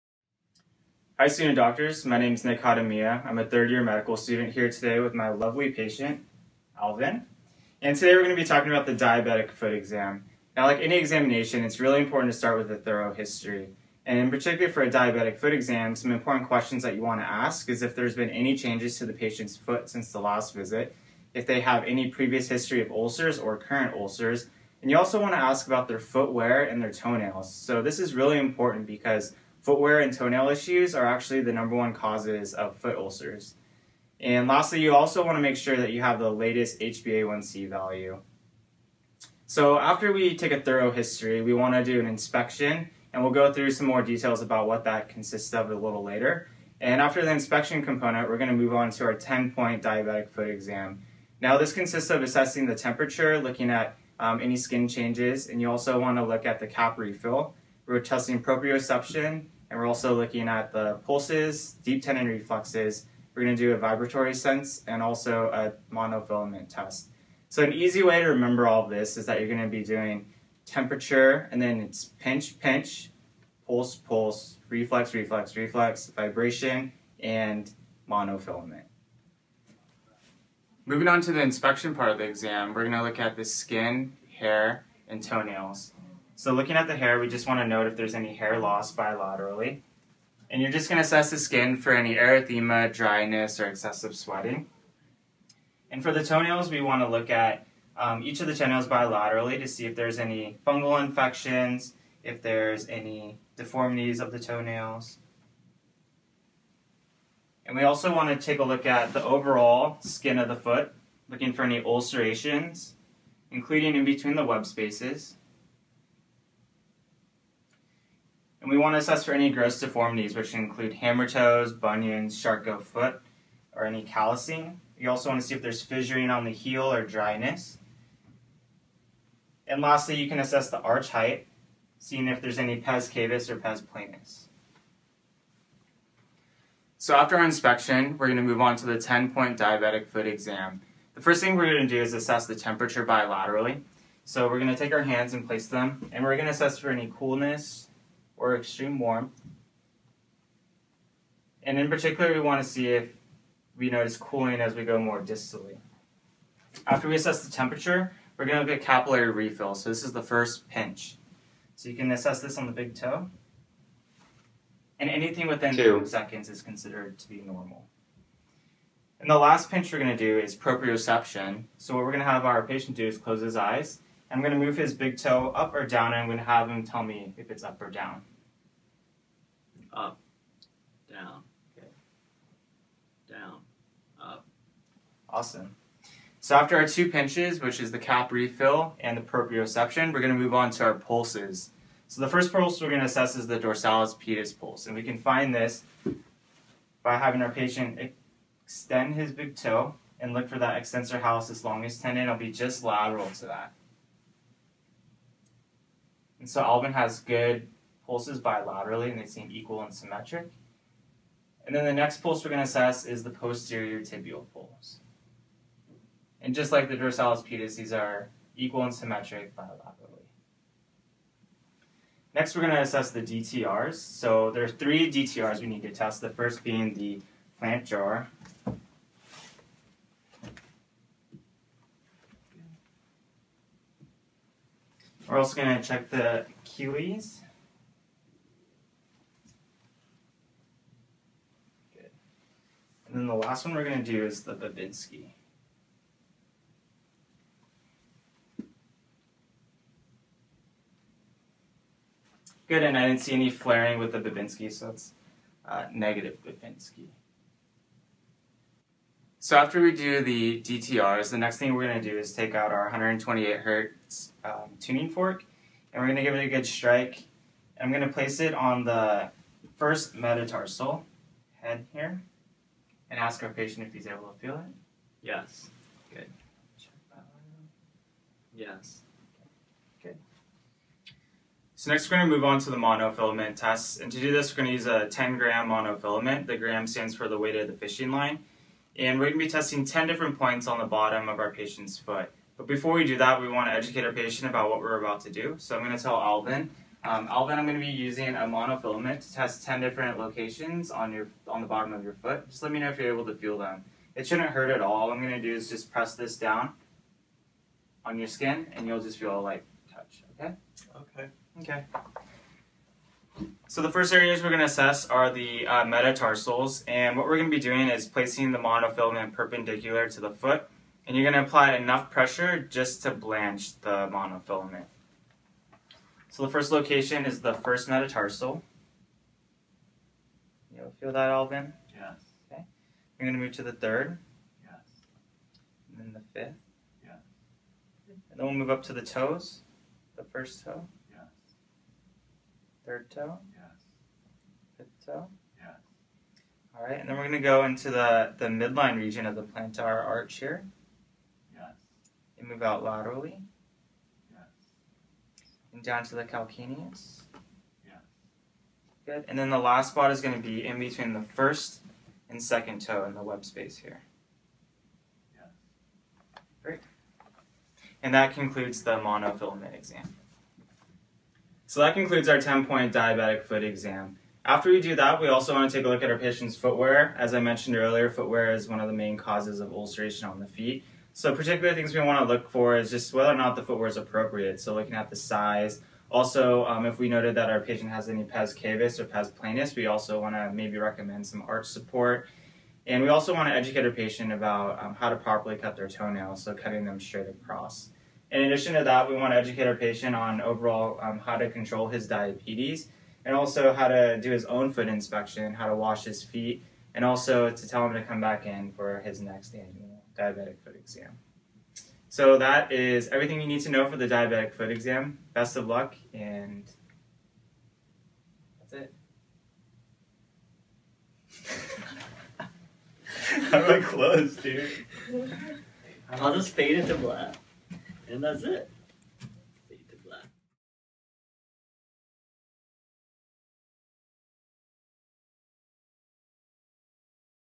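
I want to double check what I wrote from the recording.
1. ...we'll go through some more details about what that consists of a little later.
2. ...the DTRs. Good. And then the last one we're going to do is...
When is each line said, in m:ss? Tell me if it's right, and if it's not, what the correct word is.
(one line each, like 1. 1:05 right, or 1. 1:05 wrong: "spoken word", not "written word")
1. 0:43 right
2. 3:56 wrong: "Achilles", not "DTRs".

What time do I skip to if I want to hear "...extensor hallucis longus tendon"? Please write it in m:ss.
3:20.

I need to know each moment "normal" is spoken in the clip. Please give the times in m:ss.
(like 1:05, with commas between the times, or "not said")
2:47.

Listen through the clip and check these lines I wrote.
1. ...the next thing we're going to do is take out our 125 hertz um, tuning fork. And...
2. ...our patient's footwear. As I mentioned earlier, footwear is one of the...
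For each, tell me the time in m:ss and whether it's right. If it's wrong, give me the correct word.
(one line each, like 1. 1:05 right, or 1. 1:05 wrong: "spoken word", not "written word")
1. 4:21 wrong: "128", not "125"
2. 6:16 right.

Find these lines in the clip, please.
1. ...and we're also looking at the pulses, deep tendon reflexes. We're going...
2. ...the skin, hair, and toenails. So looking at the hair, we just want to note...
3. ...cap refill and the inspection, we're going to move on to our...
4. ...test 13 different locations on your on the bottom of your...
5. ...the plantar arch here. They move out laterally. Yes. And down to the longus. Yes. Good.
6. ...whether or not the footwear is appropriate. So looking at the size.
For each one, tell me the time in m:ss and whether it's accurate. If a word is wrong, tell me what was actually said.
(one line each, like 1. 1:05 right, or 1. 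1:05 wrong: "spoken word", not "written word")
1. 0:59 right
2. 1:23 right
3. 3:07 wrong: "proprioception", not "inspection"
4. 4:59 wrong: "10", not "13"
5. 5:49 wrong: "calcaneus", not "longus"
6. 6:23 right.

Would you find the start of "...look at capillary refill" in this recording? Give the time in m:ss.
2:38.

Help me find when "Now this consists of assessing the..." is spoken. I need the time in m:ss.
0:51.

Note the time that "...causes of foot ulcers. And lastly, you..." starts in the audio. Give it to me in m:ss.
0:31.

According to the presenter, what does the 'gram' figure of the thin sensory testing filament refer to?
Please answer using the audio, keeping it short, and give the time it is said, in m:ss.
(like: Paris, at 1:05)
weight of the fishing line, at 4:47.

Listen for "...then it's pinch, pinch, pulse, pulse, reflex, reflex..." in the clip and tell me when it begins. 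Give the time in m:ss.
1:11.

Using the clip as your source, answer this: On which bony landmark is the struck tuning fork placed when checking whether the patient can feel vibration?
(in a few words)
first metatarsal head.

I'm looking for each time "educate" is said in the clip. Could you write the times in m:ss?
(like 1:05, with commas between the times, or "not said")
4:53, 6:33, 6:39.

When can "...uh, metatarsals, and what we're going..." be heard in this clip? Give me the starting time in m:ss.
5:15.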